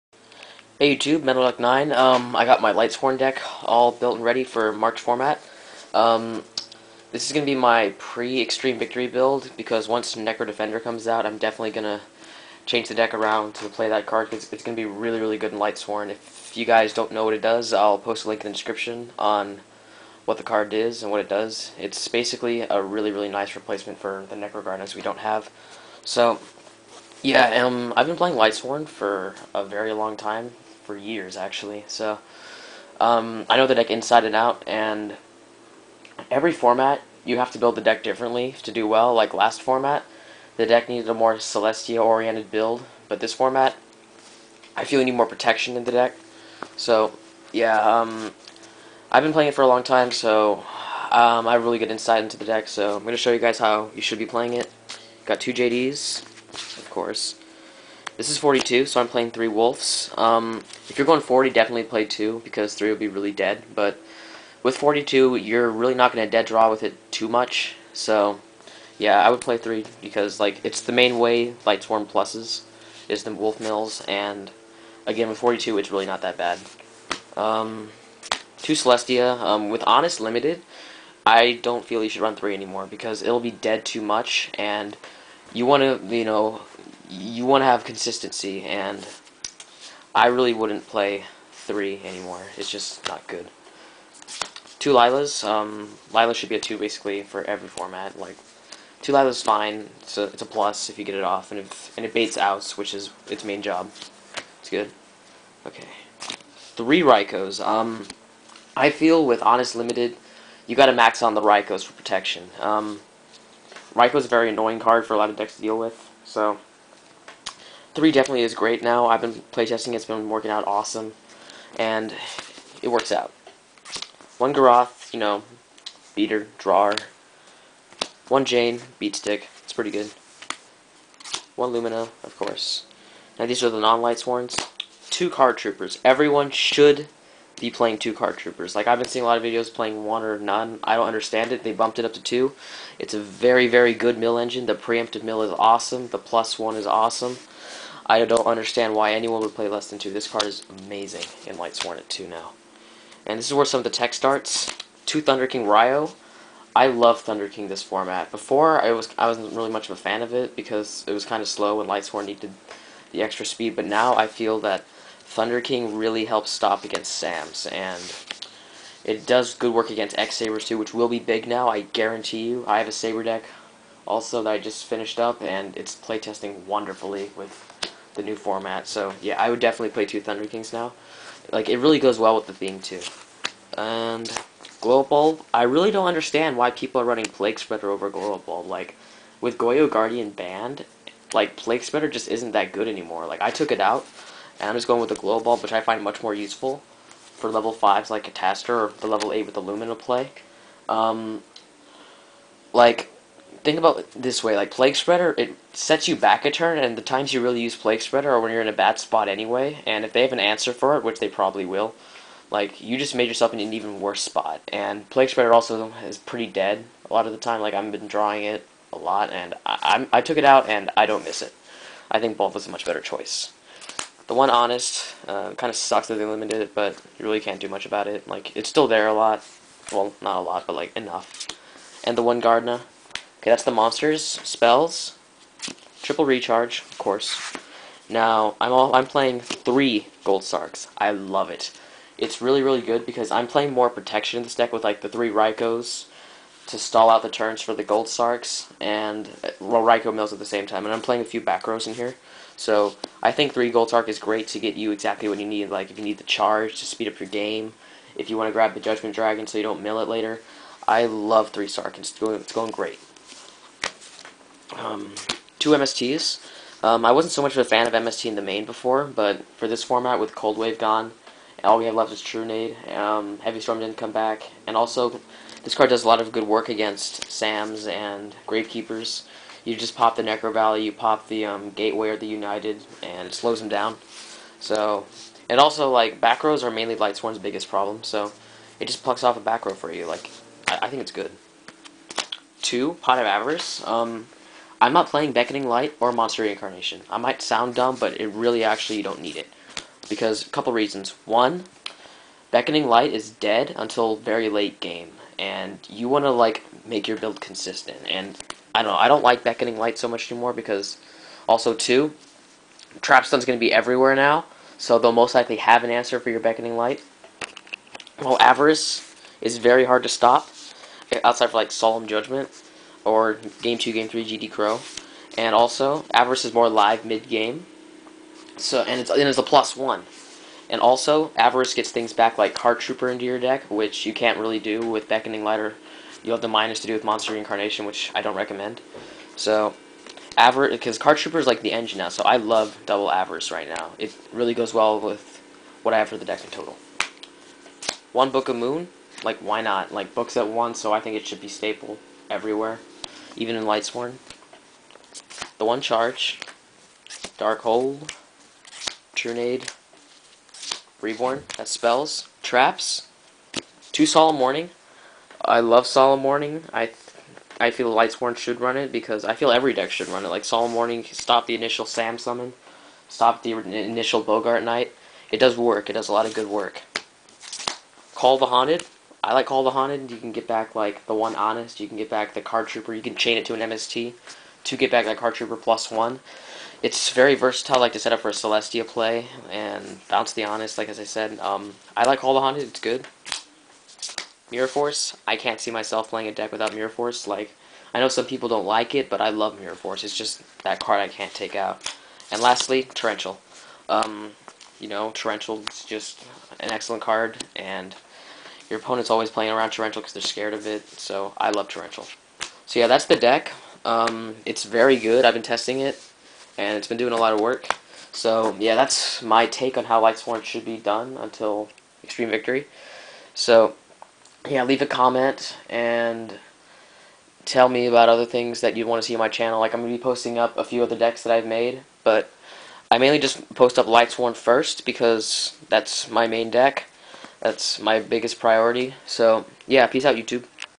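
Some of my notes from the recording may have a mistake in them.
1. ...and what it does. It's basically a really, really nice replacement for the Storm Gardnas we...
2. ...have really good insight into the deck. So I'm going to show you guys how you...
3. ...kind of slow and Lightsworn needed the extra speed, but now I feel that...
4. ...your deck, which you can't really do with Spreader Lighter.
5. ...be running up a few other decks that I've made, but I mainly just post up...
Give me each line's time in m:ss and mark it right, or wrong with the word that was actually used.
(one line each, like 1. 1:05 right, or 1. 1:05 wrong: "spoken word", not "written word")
1. 0:21 wrong: "Necro", not "Storm"
2. 0:51 right
3. 2:41 right
4. 5:33 wrong: "Beckoning", not "Spreader"
5. 7:09 wrong: "posting", not "running".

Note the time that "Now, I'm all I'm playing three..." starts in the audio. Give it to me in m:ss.
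3:58.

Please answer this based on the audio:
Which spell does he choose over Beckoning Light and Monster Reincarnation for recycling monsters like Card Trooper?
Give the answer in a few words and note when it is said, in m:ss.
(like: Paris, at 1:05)
Pot of Avarice, at 4:53.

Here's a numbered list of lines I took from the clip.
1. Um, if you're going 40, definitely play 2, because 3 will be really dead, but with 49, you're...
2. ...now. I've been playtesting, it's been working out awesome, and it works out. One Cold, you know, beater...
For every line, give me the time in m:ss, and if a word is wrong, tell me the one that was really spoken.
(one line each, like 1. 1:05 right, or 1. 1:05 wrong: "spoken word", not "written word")
1. 1:00 wrong: "42", not "49"
2. 1:58 wrong: "Garoth", not "Cold".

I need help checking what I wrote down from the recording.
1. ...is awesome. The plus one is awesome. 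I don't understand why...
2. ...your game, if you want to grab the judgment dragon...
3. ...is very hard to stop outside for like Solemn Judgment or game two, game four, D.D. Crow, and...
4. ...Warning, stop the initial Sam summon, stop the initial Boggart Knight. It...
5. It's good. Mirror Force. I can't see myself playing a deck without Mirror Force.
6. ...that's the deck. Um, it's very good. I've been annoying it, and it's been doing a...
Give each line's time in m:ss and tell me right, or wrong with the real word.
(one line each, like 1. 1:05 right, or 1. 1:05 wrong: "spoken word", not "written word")
1. 2:25 right
2. 4:17 right
3. 5:19 wrong: "three", not "four"
4. 6:10 right
5. 6:32 right
6. 6:52 wrong: "testing", not "annoying".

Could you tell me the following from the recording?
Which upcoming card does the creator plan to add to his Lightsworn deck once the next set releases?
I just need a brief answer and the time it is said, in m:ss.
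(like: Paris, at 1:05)
Necro Defender, at 0:10.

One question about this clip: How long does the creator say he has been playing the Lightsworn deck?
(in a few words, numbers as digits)
for years.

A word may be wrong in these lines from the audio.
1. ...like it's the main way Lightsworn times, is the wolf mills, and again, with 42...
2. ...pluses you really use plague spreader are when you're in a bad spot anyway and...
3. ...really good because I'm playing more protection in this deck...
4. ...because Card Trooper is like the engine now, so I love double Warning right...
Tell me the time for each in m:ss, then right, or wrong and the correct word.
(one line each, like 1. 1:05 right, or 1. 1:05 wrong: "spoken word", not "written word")
1. 1:10 wrong: "pluses", not "times"
2. 3:27 wrong: "times", not "pluses"
3. 4:02 right
4. 5:40 wrong: "Avarice", not "Warning".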